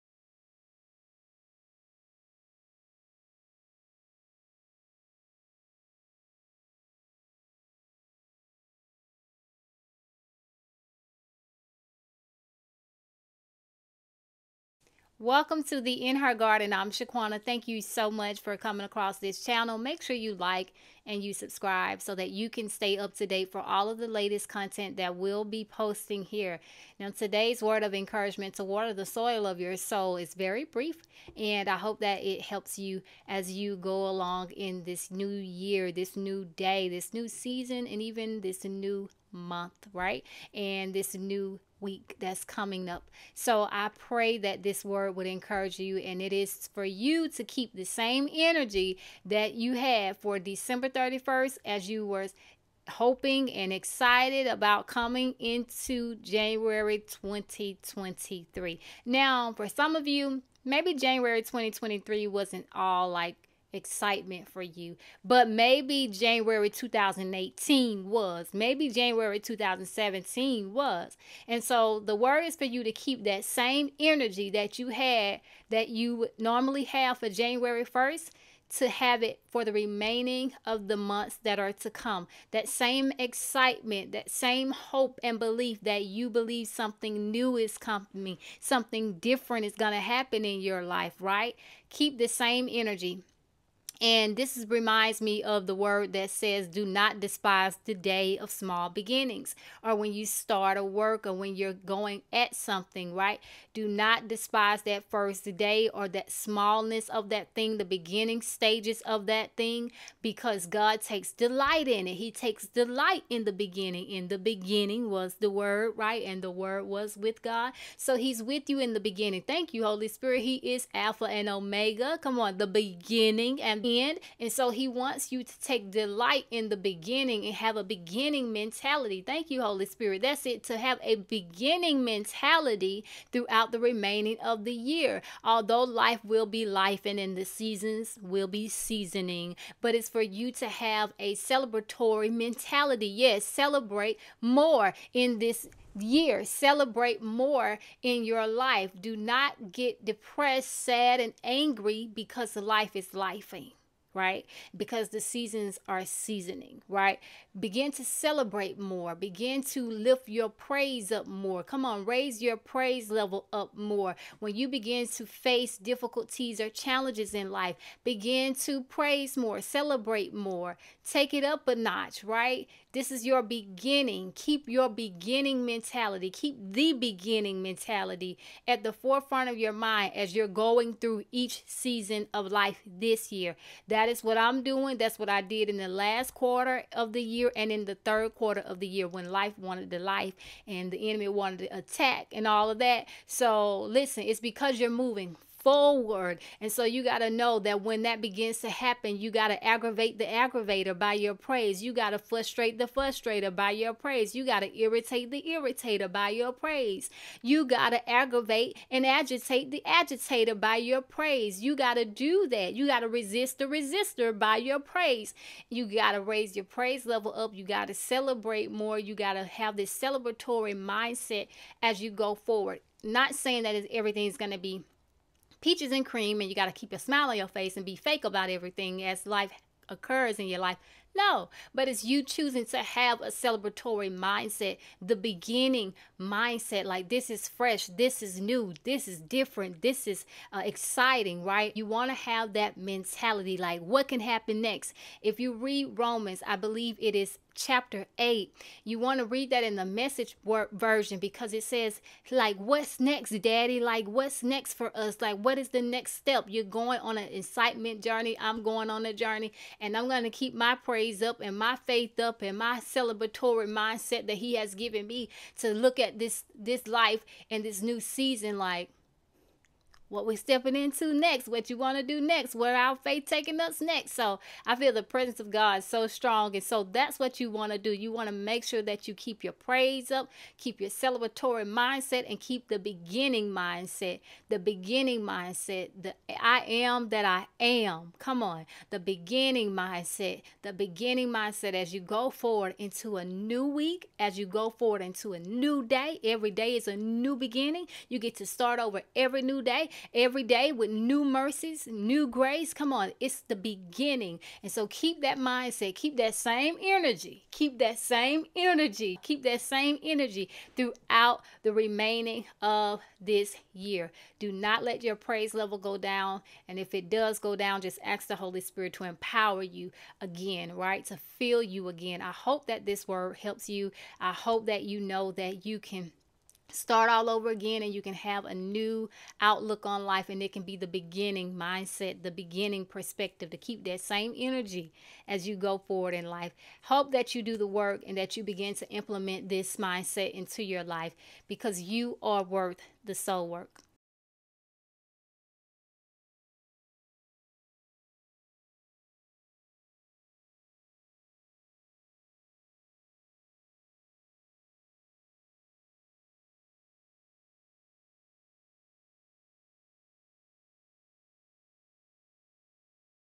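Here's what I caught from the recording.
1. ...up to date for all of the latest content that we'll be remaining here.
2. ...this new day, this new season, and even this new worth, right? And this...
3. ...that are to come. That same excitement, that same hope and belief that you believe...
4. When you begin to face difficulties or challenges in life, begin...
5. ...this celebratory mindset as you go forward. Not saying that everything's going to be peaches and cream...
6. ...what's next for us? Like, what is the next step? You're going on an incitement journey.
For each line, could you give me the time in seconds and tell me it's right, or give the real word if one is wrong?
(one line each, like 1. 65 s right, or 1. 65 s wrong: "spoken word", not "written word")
1. 22 s wrong: "posting", not "remaining"
2. 35 s wrong: "month", not "worth"
3. 81 s right
4. 164 s right
5. 219 s right
6. 254 s right.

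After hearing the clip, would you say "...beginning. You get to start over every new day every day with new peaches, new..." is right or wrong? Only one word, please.
wrong.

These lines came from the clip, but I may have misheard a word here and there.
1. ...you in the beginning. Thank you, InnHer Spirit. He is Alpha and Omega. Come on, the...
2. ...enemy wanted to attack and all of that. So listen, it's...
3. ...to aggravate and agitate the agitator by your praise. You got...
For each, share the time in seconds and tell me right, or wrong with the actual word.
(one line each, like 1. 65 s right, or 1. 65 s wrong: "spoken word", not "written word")
1. 118 s wrong: "Holy", not "InnHer"
2. 191 s right
3. 207 s right.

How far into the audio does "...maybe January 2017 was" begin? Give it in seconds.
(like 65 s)
68 s.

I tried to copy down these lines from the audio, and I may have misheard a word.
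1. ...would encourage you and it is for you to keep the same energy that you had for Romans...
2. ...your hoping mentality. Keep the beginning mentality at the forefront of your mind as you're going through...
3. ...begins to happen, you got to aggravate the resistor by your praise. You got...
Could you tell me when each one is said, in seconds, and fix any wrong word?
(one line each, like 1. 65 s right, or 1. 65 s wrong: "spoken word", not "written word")
1. 45 s wrong: "December", not "Romans"
2. 174 s wrong: "beginning", not "hoping"
3. 198 s wrong: "aggravator", not "resistor".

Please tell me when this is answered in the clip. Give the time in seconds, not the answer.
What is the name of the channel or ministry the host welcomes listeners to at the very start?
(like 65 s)
16 s.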